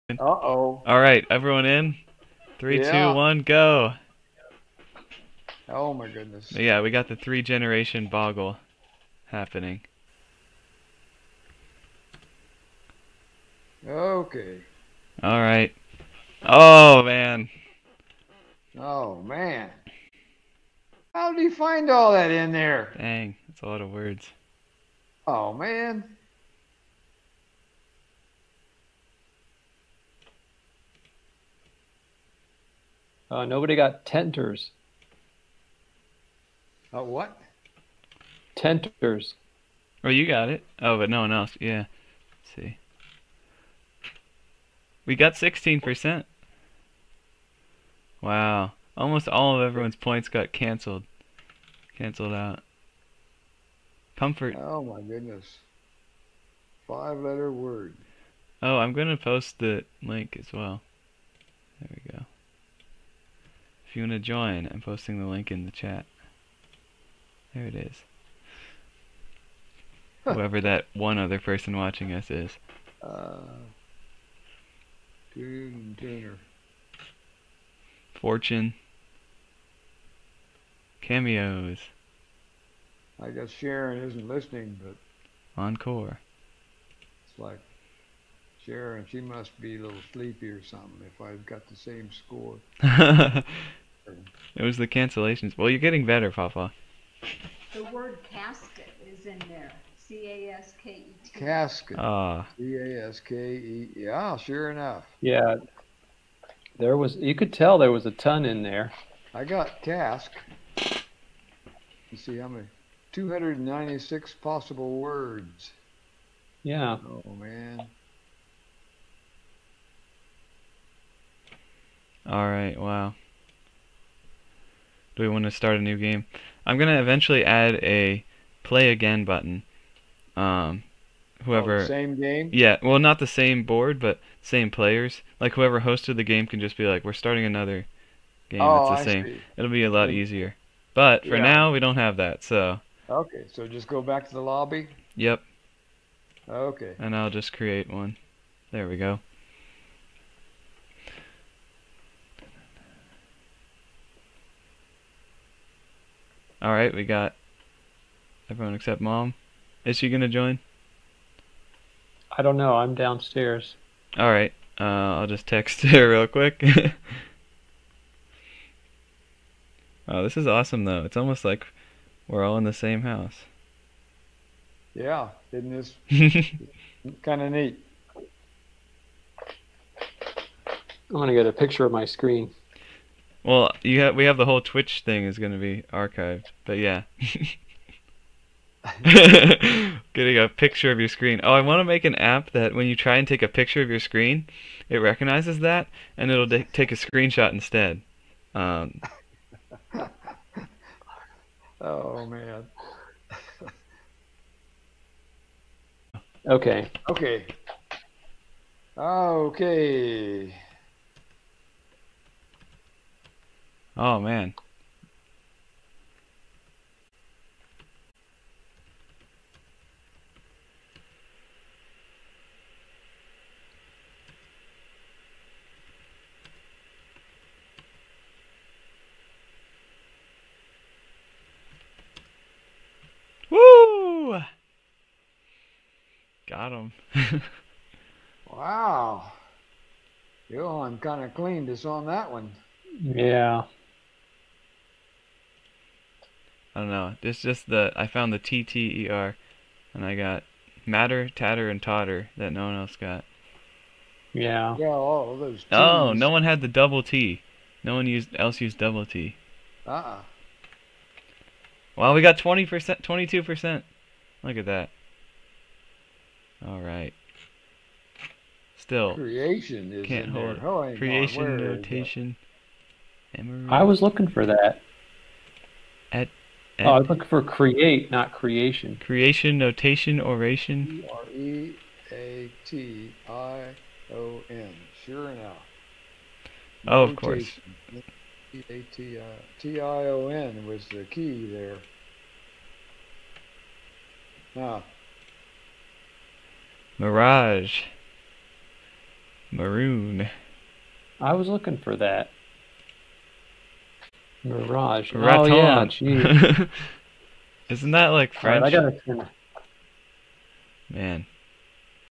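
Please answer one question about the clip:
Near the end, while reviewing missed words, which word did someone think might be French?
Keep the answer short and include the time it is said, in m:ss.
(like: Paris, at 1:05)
Raton, at 5:05.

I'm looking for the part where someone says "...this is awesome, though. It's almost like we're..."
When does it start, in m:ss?
2:50.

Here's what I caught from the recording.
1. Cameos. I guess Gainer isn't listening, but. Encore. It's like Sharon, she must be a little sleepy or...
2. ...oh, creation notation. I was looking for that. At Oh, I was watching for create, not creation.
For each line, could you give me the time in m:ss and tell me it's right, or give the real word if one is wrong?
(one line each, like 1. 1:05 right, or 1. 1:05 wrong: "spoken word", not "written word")
1. 1:21 wrong: "Sharon", not "Gainer"
2. 4:30 wrong: "looking", not "watching".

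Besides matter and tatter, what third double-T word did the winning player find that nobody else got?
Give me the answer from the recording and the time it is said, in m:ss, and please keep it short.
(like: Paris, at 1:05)
Totter, at 4:11.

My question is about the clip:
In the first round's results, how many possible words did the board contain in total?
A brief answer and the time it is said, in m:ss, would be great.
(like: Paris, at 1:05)
296, at 1:53.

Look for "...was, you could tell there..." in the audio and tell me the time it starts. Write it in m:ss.
1:46.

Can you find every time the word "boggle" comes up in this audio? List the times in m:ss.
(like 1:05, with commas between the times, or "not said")
0:08.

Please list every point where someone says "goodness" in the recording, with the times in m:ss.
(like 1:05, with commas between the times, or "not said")
0:06, 0:55.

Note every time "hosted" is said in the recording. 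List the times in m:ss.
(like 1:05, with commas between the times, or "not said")
2:15.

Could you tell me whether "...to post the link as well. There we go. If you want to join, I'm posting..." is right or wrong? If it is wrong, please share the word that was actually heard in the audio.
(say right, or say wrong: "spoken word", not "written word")
right.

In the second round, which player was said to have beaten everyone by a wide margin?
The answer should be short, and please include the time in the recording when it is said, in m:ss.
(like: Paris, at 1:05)
Johan, at 4:00.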